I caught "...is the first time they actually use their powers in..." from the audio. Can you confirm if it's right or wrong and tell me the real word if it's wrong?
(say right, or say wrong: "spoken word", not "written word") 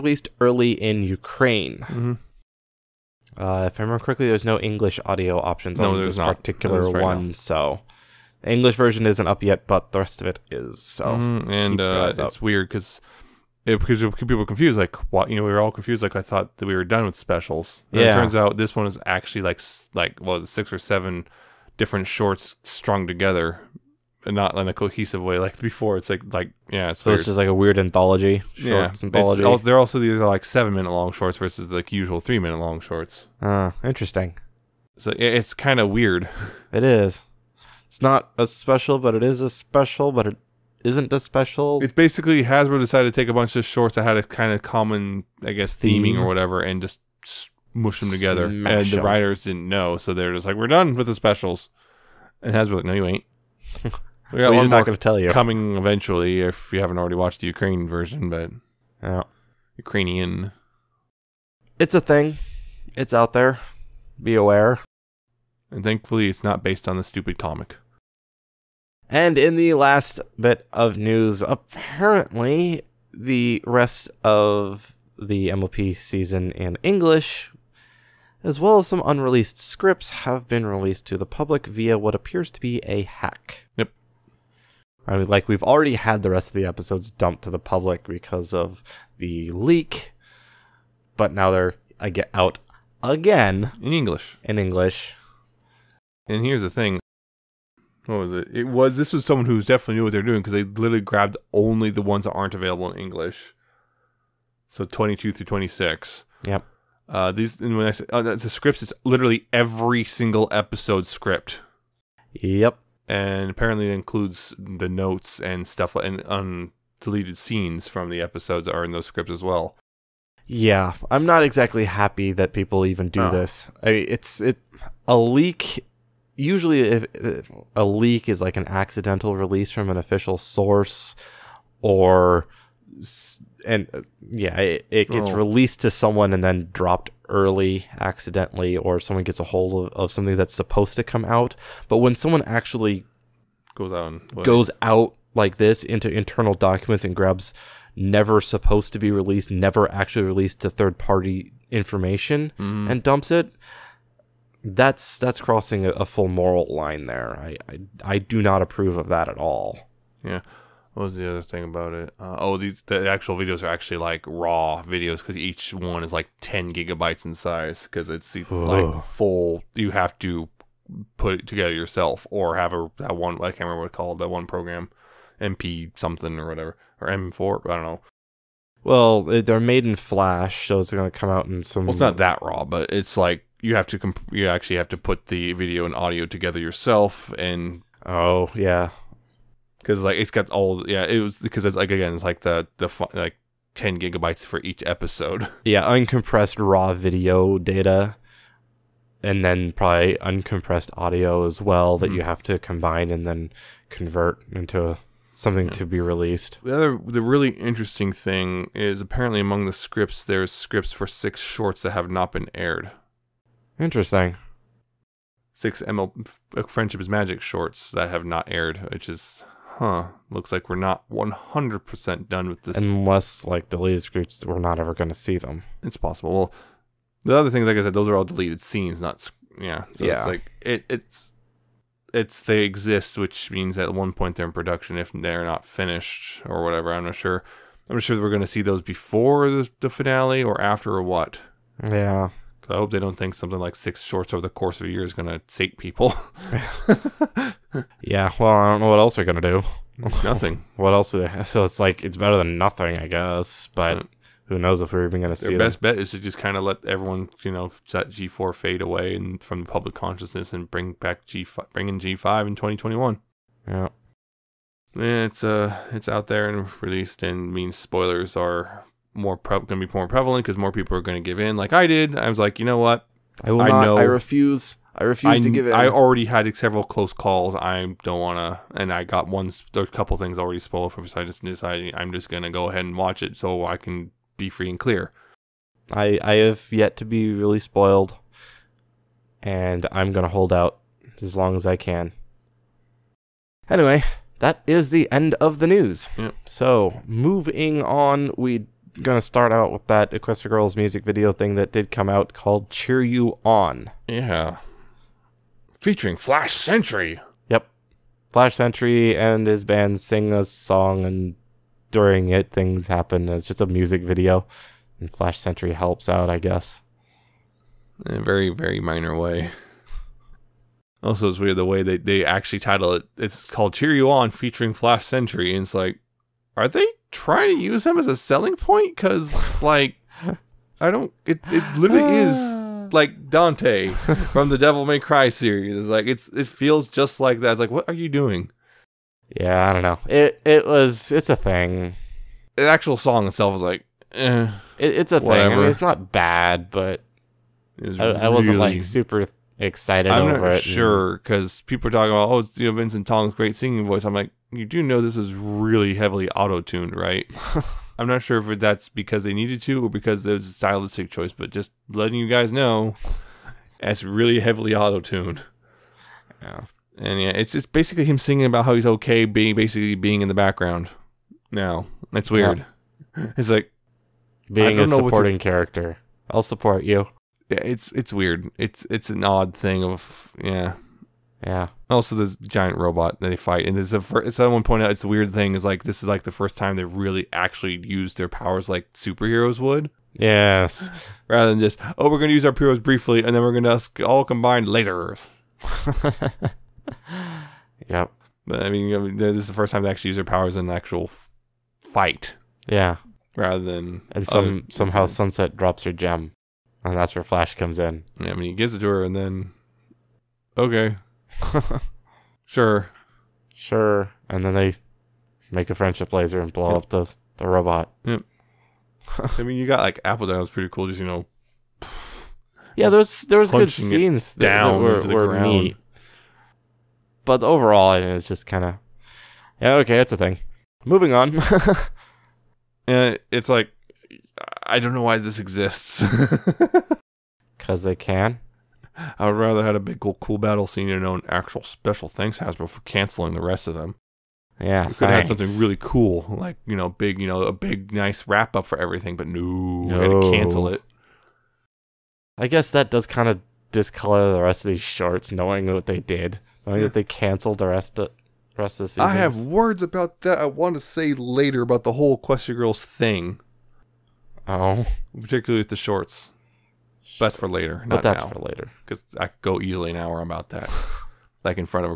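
right.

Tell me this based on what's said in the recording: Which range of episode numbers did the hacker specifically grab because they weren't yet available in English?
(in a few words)
22 through 26.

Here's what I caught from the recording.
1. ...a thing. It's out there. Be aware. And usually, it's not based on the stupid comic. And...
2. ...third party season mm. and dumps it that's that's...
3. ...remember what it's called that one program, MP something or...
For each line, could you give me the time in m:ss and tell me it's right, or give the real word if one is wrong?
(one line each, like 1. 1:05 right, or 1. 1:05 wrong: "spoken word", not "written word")
1. 1:01 wrong: "thankfully", not "usually"
2. 2:30 wrong: "information", not "season"
3. 2:53 right.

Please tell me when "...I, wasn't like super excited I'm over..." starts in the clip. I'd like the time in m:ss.
5:48.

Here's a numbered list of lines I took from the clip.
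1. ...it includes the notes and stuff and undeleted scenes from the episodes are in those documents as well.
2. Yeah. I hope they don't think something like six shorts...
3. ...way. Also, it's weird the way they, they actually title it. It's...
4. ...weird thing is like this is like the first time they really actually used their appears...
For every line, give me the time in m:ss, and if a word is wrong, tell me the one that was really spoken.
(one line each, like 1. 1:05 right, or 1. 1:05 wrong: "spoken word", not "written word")
1. 1:53 wrong: "scripts", not "documents"
2. 4:01 right
3. 5:19 right
4. 6:25 wrong: "powers", not "appears".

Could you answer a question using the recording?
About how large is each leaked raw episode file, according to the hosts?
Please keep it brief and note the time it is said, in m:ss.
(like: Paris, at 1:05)
10 gigabytes, at 2:46.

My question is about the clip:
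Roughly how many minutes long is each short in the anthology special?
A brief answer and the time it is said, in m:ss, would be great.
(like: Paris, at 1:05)
7 minutes, at 0:30.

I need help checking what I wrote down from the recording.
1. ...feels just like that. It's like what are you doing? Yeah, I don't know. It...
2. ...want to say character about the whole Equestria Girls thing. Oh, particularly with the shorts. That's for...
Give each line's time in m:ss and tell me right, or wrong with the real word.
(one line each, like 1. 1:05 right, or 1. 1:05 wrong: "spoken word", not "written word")
1. 5:36 right
2. 7:40 wrong: "later", not "character".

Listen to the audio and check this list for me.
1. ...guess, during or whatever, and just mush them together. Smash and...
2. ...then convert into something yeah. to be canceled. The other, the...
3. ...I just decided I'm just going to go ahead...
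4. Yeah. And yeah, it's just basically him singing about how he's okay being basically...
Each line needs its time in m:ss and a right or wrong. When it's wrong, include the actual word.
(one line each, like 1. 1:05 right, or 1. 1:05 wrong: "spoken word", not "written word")
1. 0:45 wrong: "theming", not "during"
2. 3:23 wrong: "released", not "canceled"
3. 4:41 right
4. 6:06 right.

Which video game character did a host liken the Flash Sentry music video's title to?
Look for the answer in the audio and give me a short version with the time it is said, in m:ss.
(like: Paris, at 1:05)
Dante, at 5:33.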